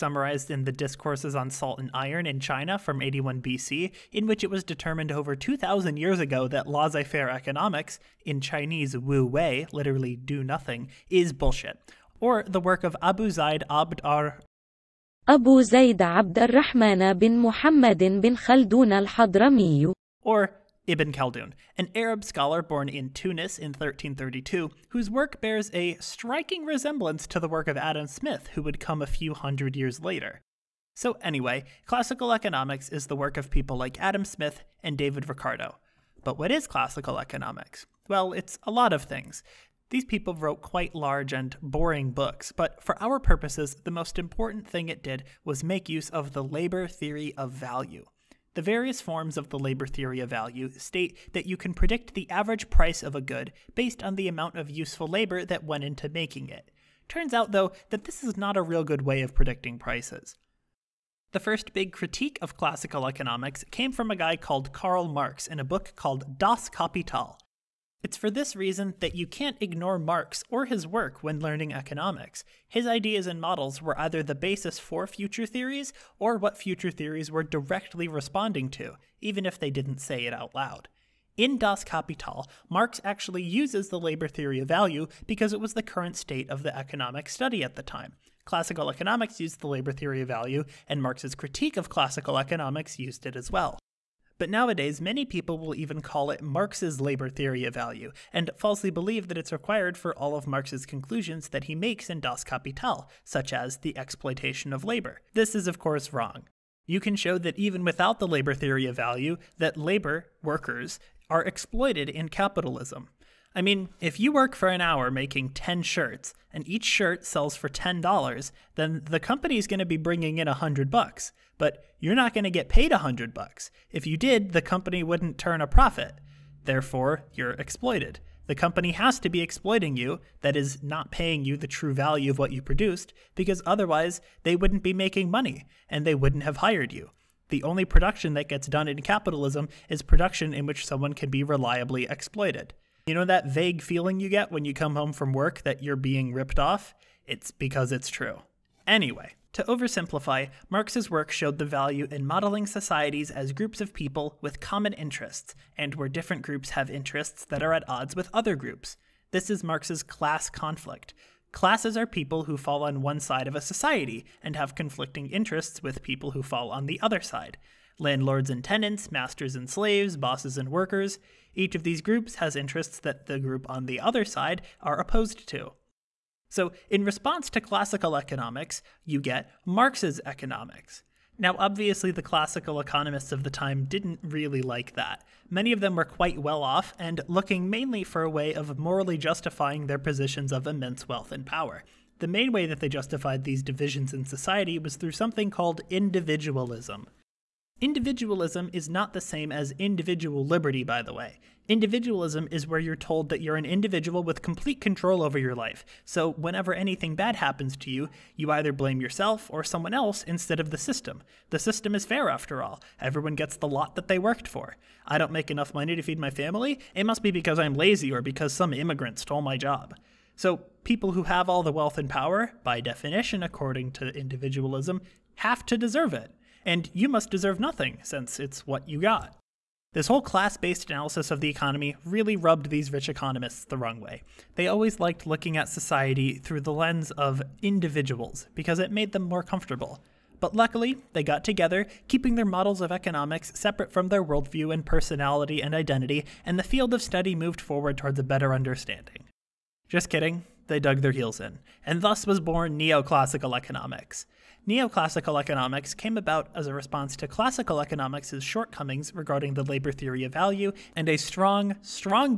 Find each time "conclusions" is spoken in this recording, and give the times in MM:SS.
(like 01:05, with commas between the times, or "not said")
01:40.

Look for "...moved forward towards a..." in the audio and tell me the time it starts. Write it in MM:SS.
04:07.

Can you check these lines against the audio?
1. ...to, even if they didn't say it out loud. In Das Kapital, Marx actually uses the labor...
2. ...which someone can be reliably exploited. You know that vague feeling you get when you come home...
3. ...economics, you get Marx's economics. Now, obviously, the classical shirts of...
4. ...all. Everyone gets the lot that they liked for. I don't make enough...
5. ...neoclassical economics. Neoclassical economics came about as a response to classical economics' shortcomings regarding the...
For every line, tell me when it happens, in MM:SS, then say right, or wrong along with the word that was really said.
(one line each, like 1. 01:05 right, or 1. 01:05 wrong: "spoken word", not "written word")
1. 01:18 right
2. 02:20 right
3. 02:58 wrong: "economists", not "shirts"
4. 03:32 wrong: "worked", not "liked"
5. 04:12 right.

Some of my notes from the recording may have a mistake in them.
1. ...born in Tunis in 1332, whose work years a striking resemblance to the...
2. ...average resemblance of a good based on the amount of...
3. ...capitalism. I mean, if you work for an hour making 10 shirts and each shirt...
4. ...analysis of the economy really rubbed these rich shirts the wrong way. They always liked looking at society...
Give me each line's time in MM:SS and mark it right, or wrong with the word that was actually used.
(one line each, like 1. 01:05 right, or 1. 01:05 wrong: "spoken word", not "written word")
1. 00:22 wrong: "bears", not "years"
2. 00:52 wrong: "price", not "resemblance"
3. 01:52 right
4. 03:50 wrong: "economists", not "shirts".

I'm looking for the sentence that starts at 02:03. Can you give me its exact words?
If you did, the company wouldn't turn a profit.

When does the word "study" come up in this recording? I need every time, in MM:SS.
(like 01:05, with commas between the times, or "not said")
01:27, 04:07.